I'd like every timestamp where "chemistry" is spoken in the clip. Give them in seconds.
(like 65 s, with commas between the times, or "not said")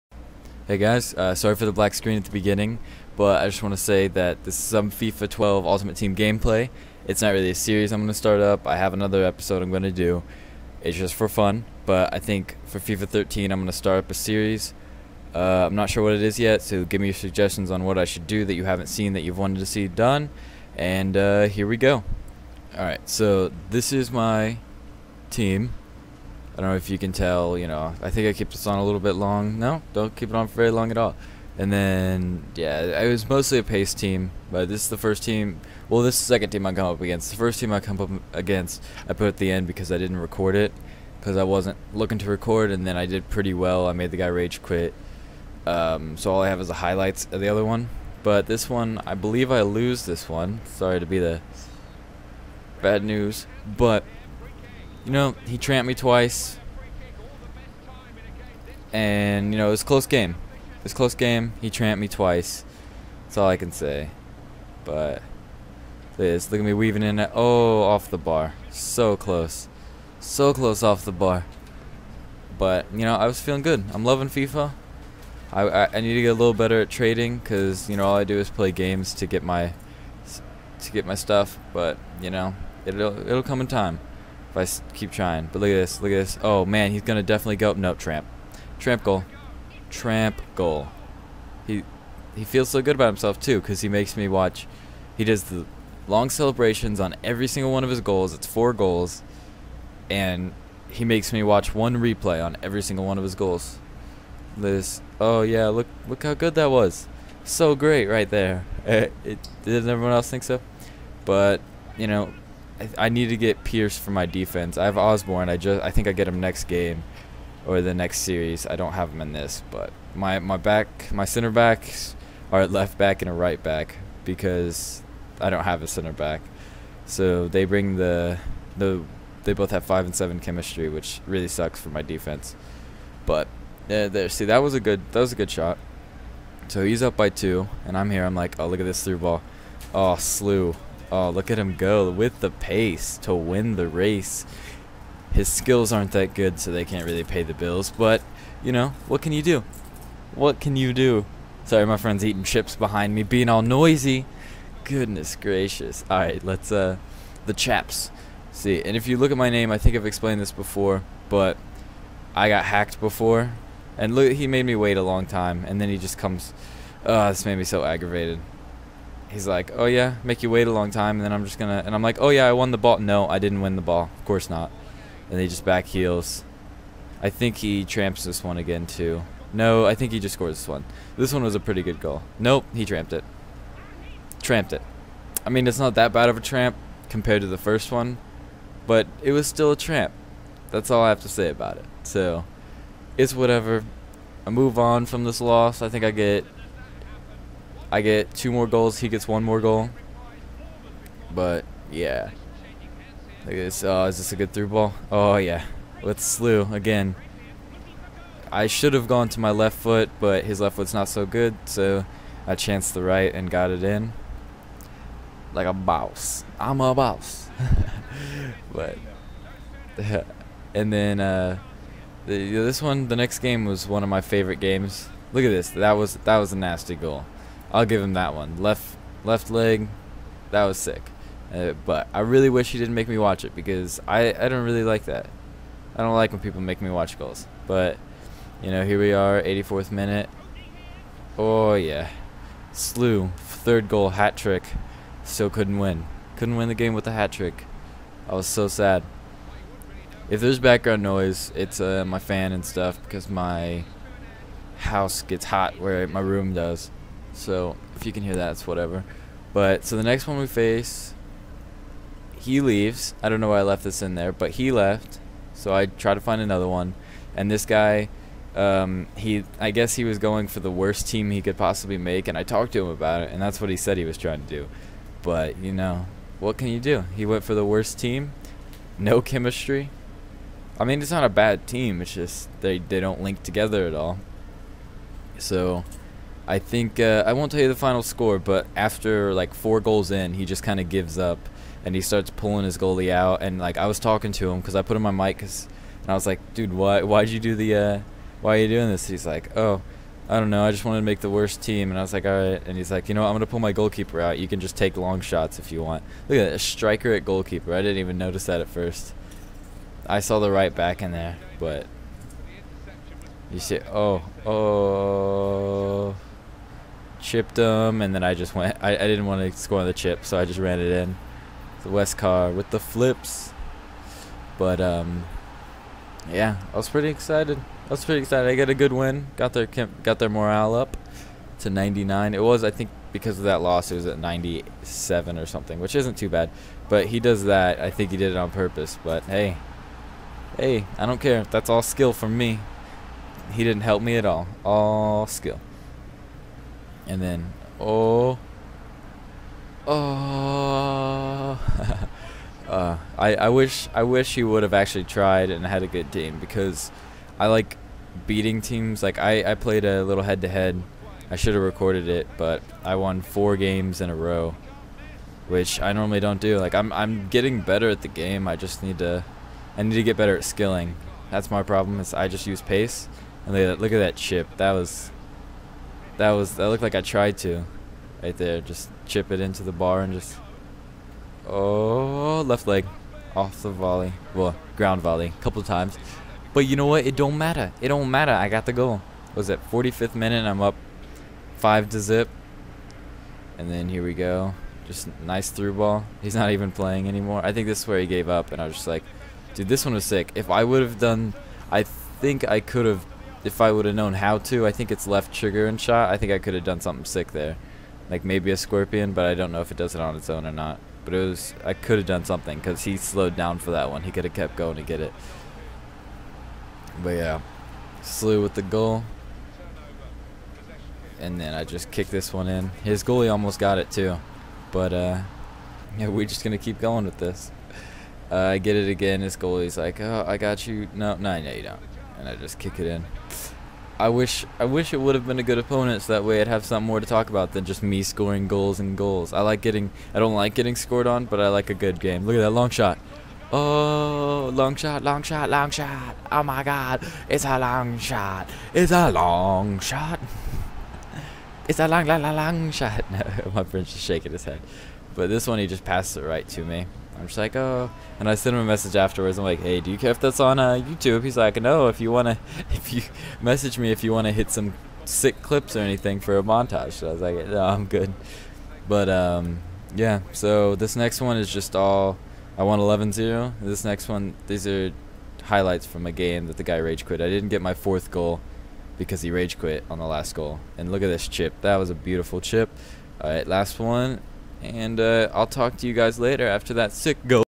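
130 s, 279 s.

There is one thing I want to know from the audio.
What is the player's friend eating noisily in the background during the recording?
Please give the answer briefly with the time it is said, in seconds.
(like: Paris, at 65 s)
chips, at 152 s.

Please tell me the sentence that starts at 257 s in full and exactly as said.
So if you can hear that, it's whatever.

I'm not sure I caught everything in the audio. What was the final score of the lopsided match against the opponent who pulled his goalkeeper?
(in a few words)
11-0.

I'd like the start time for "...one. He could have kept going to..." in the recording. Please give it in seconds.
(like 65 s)
413 s.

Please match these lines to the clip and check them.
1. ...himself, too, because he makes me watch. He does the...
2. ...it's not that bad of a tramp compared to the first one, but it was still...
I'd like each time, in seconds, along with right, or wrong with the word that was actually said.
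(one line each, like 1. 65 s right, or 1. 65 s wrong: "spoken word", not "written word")
1. 93 s right
2. 185 s right.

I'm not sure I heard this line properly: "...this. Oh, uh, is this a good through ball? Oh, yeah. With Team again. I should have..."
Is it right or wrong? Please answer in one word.
wrong.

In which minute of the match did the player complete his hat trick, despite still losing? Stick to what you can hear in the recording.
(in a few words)
84th minute.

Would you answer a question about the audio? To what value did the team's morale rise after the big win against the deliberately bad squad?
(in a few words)
99.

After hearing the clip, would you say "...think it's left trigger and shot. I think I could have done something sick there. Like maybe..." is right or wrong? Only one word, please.
right.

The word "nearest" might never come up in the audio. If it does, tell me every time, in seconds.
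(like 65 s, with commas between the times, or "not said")
not said.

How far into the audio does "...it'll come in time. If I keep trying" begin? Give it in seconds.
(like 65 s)
83 s.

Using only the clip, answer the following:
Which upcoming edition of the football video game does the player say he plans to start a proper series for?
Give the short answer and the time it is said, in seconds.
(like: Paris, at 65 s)
FIFA 13, at 12 s.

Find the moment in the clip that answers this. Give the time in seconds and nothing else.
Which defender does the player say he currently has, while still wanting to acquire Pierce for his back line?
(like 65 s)
114 s.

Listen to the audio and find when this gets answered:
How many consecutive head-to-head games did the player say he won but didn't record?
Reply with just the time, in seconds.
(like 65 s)
363 s.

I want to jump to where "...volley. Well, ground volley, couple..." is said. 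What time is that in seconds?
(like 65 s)
383 s.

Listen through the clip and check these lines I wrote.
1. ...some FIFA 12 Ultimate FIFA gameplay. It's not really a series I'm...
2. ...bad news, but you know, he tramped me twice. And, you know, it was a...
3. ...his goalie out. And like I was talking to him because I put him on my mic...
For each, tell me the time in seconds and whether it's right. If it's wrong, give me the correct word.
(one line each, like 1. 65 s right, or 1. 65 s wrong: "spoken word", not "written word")
1. 4 s wrong: "Team", not "FIFA"
2. 52 s right
3. 292 s right.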